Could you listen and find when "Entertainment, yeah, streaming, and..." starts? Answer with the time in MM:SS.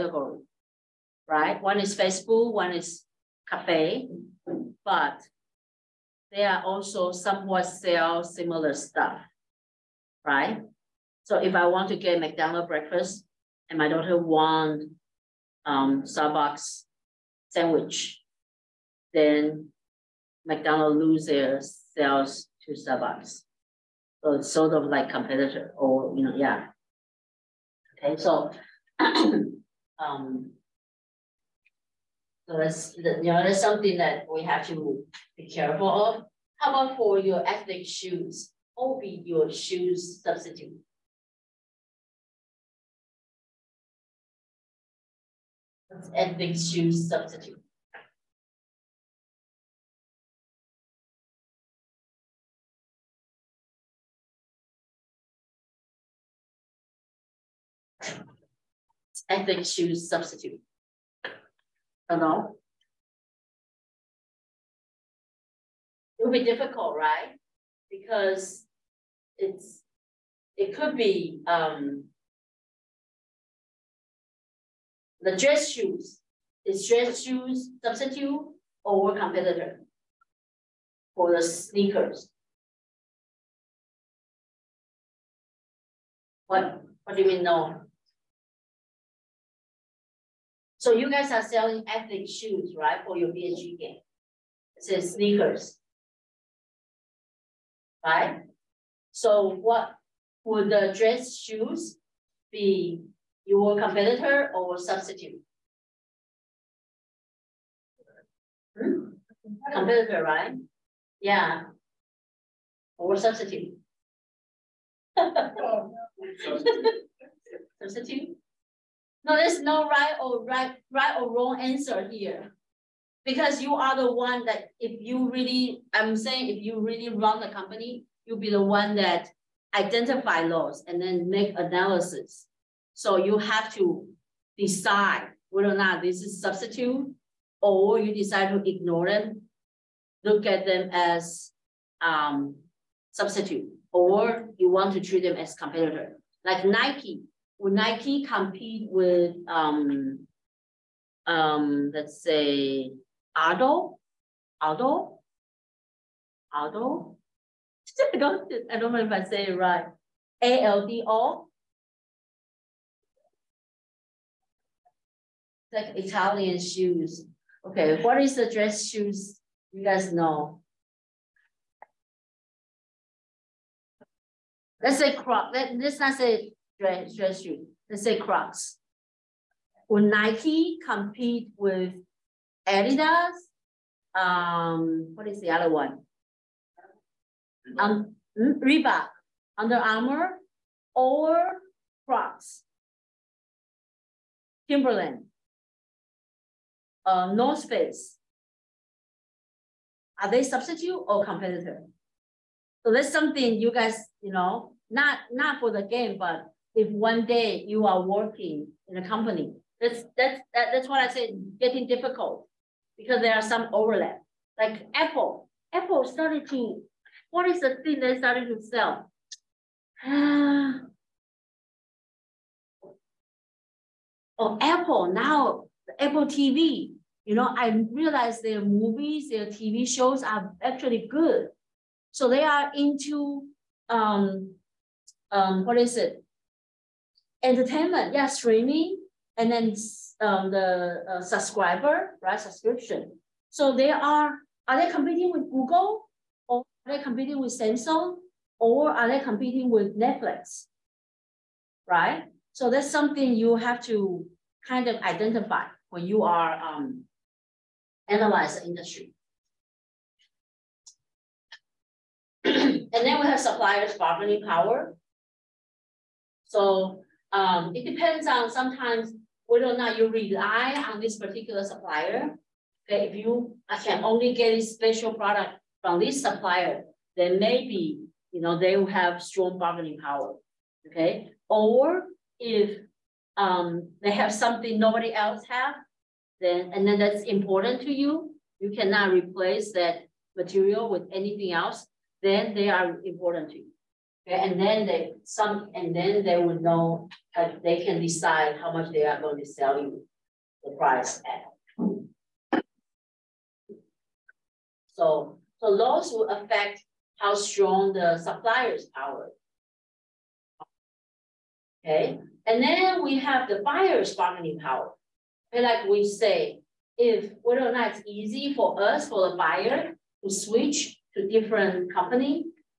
03:57.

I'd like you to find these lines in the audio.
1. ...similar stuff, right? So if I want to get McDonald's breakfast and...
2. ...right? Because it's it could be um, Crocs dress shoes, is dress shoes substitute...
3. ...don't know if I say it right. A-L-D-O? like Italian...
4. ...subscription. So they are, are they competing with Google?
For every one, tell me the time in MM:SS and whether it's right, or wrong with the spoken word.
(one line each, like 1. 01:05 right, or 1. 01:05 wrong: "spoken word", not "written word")
1. 00:08 right
2. 01:06 wrong: "The", not "Crocs"
3. 02:38 right
4. 04:02 right.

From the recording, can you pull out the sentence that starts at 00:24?
So it's sort of like competitor or, you know, yeah.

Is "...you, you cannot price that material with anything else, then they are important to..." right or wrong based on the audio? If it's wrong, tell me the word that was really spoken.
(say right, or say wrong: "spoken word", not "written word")
wrong: "replace", not "price".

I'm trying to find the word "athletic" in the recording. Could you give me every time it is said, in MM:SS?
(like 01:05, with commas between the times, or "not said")
00:37, 01:31.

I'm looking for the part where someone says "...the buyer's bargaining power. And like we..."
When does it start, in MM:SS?
05:13.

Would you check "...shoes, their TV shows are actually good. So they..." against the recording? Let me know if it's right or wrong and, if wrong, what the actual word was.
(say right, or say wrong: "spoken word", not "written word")
wrong: "movies", not "shoes".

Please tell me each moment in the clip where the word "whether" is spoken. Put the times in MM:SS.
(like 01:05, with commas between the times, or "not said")
02:15, 04:29, 05:17.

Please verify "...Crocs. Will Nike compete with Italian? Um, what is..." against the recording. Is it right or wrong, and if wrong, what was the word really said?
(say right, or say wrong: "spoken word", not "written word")
wrong: "Adidas", not "Italian".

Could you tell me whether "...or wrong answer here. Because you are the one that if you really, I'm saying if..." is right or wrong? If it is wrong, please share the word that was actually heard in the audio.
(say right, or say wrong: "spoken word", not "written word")
right.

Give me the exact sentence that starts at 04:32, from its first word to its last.
Okay, if you can only get a special product from this supplier, then maybe you know they will have strong bargaining power.